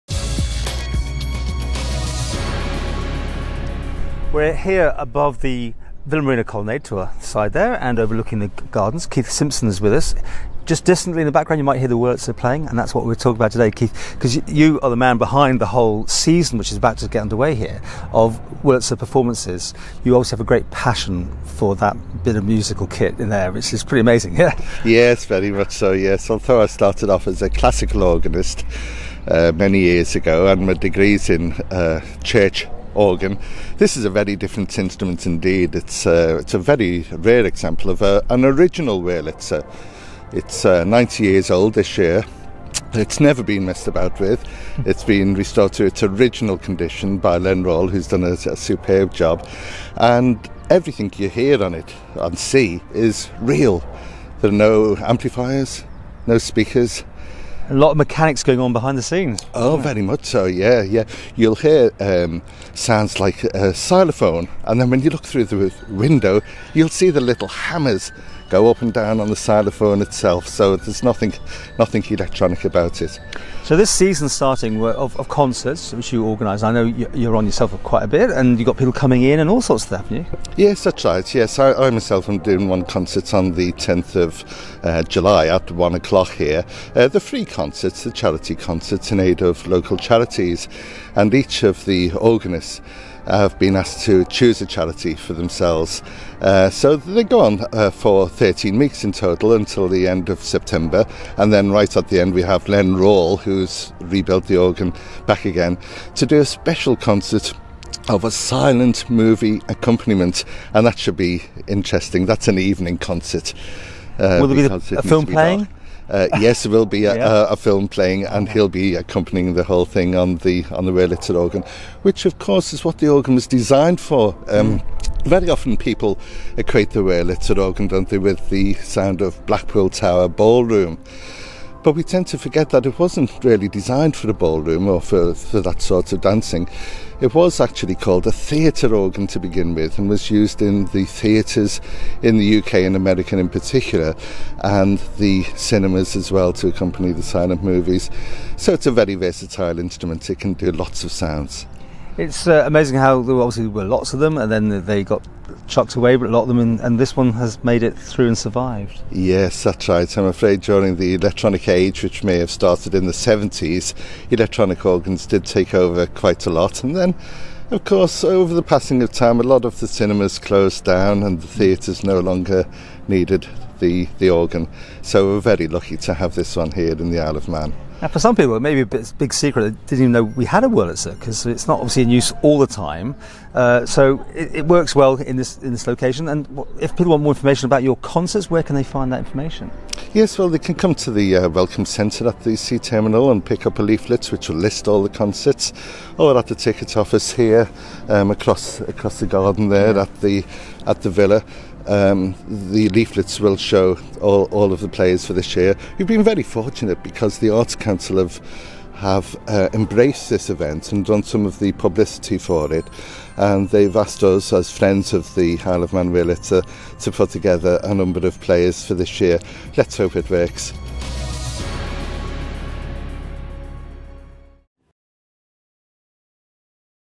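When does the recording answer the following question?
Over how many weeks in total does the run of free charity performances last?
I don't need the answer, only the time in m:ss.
1:38.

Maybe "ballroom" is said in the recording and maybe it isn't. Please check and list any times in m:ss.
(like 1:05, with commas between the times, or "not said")
2:10, 2:14.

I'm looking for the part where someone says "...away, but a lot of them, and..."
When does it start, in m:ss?
2:35.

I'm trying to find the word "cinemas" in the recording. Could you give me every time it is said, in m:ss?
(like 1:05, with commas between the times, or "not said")
2:25, 2:49.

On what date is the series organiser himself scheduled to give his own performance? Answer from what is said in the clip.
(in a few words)
10th of July.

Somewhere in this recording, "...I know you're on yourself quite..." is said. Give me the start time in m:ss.
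1:16.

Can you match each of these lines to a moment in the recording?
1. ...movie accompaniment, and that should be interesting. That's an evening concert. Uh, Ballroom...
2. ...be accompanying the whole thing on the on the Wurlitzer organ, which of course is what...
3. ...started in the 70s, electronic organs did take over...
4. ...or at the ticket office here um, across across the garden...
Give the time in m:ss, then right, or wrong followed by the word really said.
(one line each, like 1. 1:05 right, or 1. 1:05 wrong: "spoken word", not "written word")
1. 1:49 wrong: "Will", not "Ballroom"
2. 1:58 right
3. 2:42 right
4. 3:16 right.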